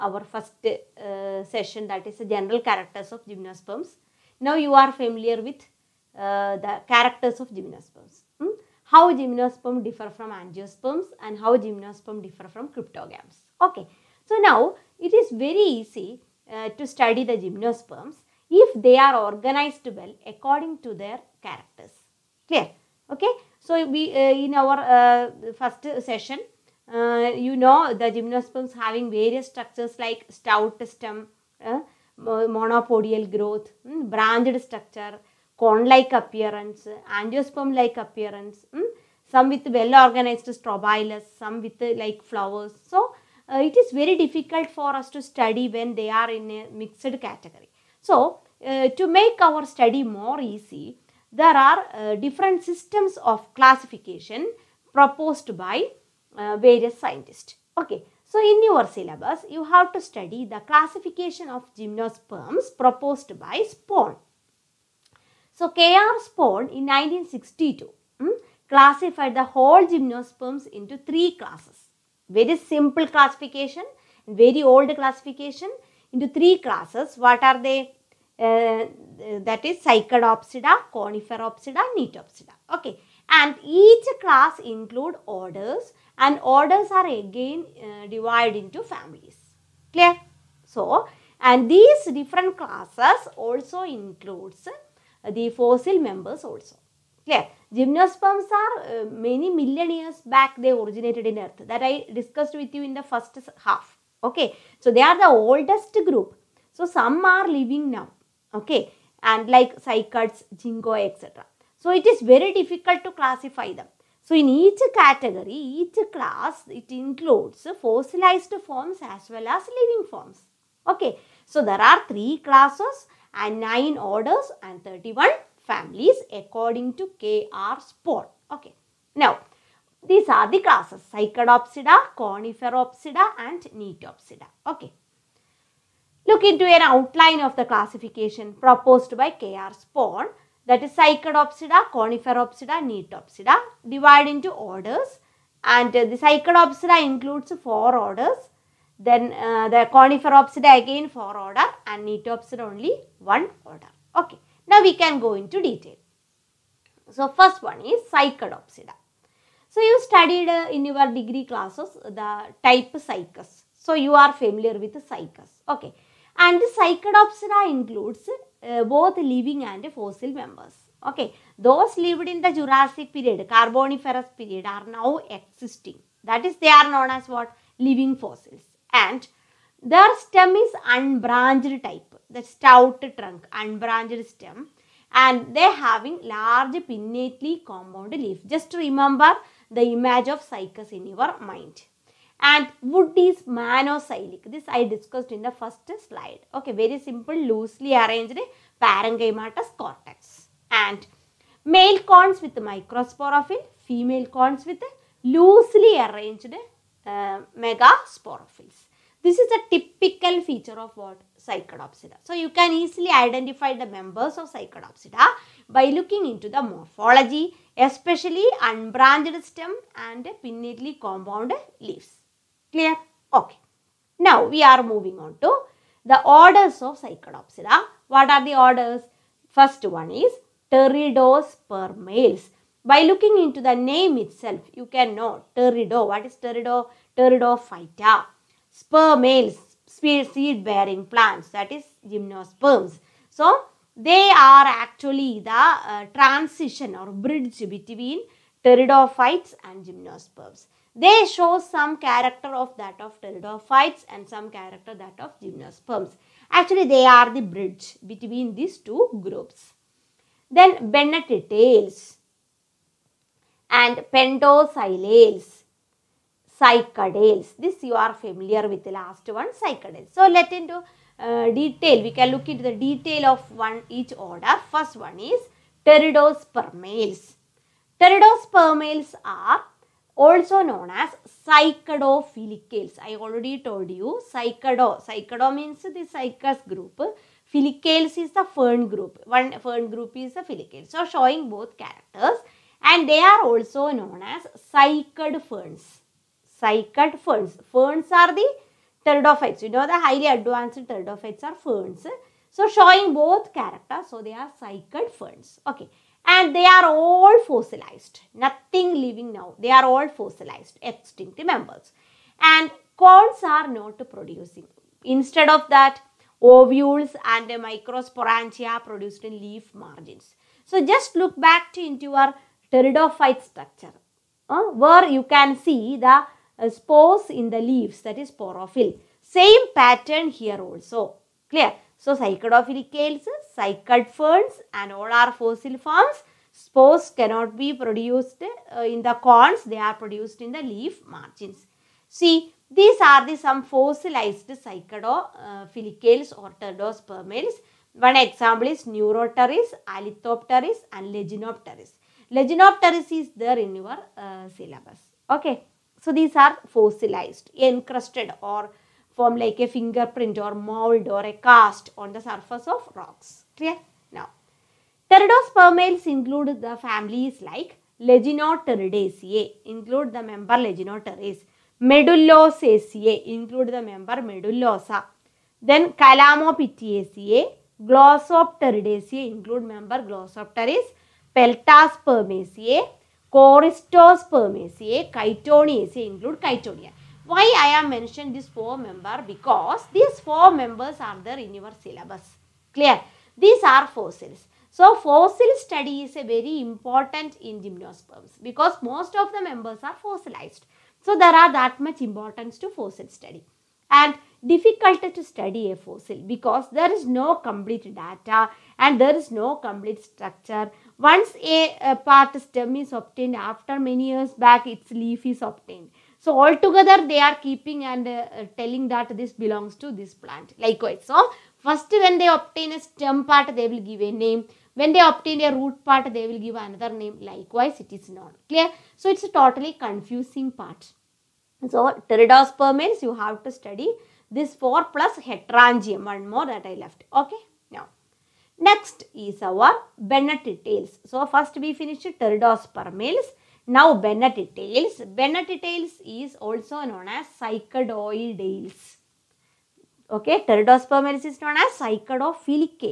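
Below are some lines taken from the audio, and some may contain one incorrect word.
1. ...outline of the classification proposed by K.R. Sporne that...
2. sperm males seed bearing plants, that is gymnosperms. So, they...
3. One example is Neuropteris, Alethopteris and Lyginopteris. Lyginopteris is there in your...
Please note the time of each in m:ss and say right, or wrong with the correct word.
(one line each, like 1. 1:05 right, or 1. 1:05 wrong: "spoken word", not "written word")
1. 2:16 right
2. 3:58 right
3. 5:47 right.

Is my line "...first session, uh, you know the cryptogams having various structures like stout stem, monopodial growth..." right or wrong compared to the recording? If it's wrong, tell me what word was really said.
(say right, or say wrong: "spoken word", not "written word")
wrong: "gymnosperms", not "cryptogams".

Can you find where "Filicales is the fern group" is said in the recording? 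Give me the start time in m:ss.
4:47.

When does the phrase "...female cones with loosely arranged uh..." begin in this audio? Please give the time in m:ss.
3:23.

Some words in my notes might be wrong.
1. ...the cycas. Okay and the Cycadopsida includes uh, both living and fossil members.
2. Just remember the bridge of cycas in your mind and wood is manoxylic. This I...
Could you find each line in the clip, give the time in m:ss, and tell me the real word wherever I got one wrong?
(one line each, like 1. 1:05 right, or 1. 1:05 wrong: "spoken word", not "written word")
1. 2:44 right
2. 3:08 wrong: "image", not "bridge".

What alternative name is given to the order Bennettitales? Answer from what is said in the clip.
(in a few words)
Cycadoidales.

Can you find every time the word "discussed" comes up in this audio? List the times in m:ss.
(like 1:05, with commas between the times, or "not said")
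1:42, 3:14.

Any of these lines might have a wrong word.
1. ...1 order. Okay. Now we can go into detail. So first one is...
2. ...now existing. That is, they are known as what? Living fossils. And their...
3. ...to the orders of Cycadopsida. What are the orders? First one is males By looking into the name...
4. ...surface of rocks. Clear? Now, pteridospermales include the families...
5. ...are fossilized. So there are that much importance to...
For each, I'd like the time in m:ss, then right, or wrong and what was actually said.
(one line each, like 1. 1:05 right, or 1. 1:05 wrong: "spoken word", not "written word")
1. 2:33 right
2. 2:54 right
3. 3:45 right
4. 6:02 right
5. 6:39 right.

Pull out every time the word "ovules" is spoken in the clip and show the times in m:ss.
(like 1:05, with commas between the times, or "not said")
5:16.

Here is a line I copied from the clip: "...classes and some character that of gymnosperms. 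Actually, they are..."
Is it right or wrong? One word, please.
wrong.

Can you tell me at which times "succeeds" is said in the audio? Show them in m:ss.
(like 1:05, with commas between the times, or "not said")
not said.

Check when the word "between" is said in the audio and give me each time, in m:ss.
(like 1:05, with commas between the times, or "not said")
4:07, 4:18.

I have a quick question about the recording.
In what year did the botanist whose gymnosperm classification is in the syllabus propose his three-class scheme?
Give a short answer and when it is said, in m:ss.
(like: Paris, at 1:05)
1962, at 1:06.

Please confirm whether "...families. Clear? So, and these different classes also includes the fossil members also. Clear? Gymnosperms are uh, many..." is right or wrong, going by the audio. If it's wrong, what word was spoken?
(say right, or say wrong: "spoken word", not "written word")
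right.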